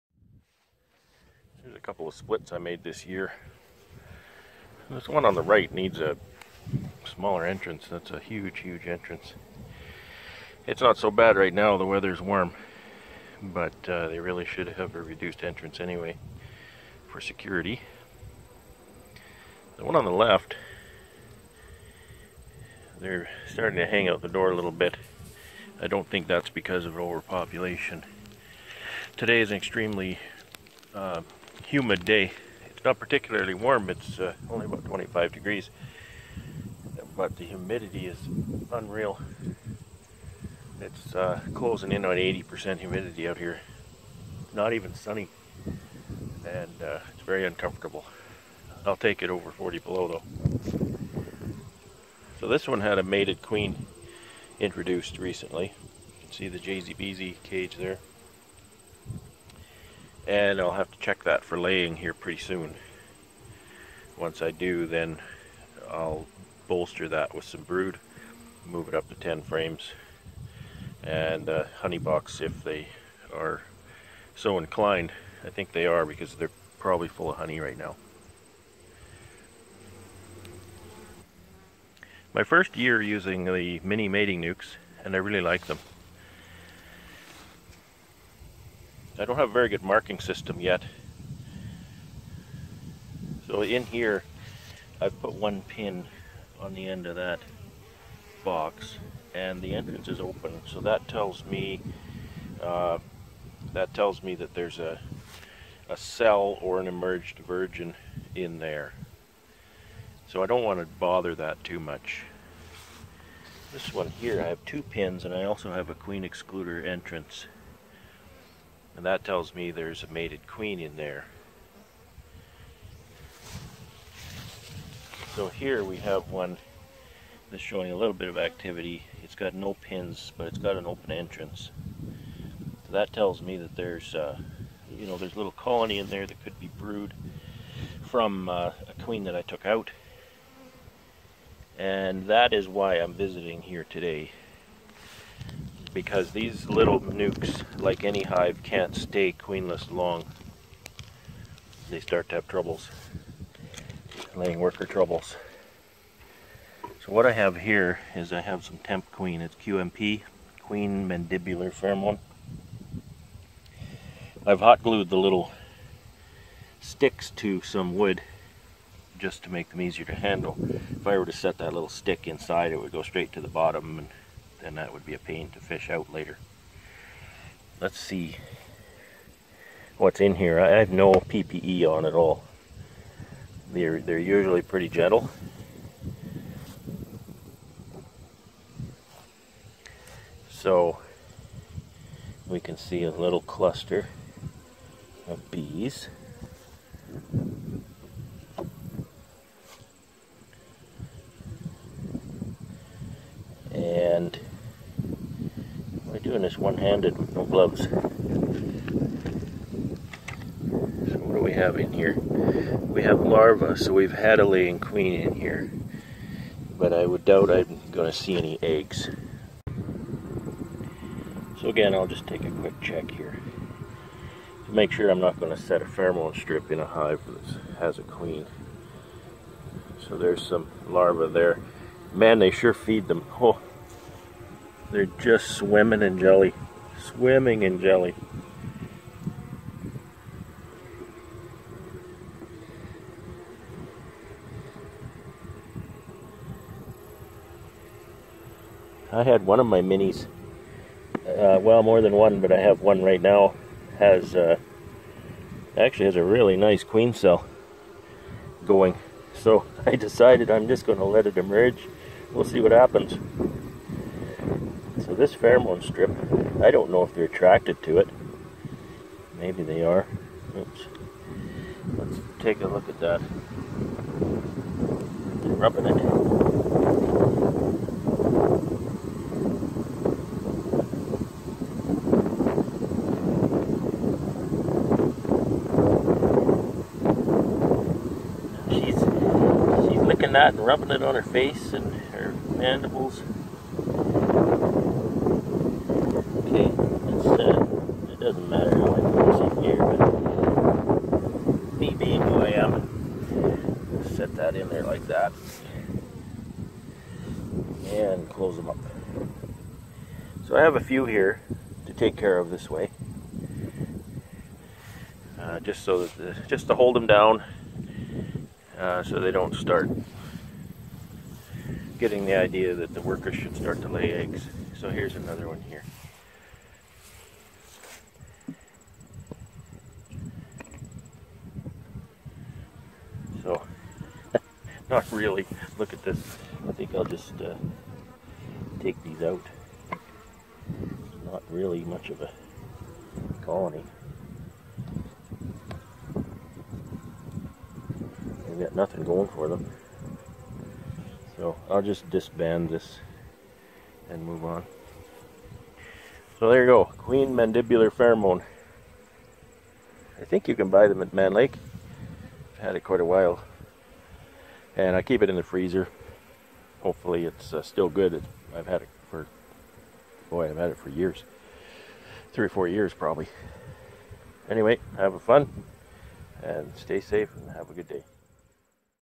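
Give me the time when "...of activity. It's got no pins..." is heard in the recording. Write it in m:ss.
2:08.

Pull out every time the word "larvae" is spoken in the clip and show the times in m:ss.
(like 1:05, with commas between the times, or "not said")
3:33, 3:50.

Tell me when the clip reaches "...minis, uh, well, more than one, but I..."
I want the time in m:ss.
4:09.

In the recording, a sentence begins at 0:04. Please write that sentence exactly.
This one on the right needs a smaller entrance.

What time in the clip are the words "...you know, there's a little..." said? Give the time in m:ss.
2:14.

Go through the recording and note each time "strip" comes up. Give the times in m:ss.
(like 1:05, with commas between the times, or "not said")
3:46, 4:25.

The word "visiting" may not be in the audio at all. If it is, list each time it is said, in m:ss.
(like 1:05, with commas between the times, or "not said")
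2:23.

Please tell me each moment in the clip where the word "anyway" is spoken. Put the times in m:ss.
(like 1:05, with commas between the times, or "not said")
0:15, 6:14.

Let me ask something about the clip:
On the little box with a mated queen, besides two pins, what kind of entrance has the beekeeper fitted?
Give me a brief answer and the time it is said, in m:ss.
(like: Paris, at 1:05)
queen excluder entrance, at 1:55.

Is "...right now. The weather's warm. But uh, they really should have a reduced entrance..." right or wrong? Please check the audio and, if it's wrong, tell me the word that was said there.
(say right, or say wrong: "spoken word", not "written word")
right.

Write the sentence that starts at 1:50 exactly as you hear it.
So I don't want to bother that too much.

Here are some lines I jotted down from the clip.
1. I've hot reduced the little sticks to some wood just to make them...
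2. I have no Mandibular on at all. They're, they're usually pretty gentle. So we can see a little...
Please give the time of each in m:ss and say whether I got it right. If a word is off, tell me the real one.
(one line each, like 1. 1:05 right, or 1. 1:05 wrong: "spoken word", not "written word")
1. 2:44 wrong: "glued", not "reduced"
2. 3:00 wrong: "PPE", not "Mandibular".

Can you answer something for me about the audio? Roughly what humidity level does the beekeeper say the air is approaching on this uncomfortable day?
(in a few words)
80%.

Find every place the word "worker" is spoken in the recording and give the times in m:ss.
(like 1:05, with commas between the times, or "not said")
2:34, 5:23.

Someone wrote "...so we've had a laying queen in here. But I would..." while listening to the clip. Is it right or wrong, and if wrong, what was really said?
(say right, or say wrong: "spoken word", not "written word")
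right.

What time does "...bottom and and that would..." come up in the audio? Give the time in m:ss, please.
2:53.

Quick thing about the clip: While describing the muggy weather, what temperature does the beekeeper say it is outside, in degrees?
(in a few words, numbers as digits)
25.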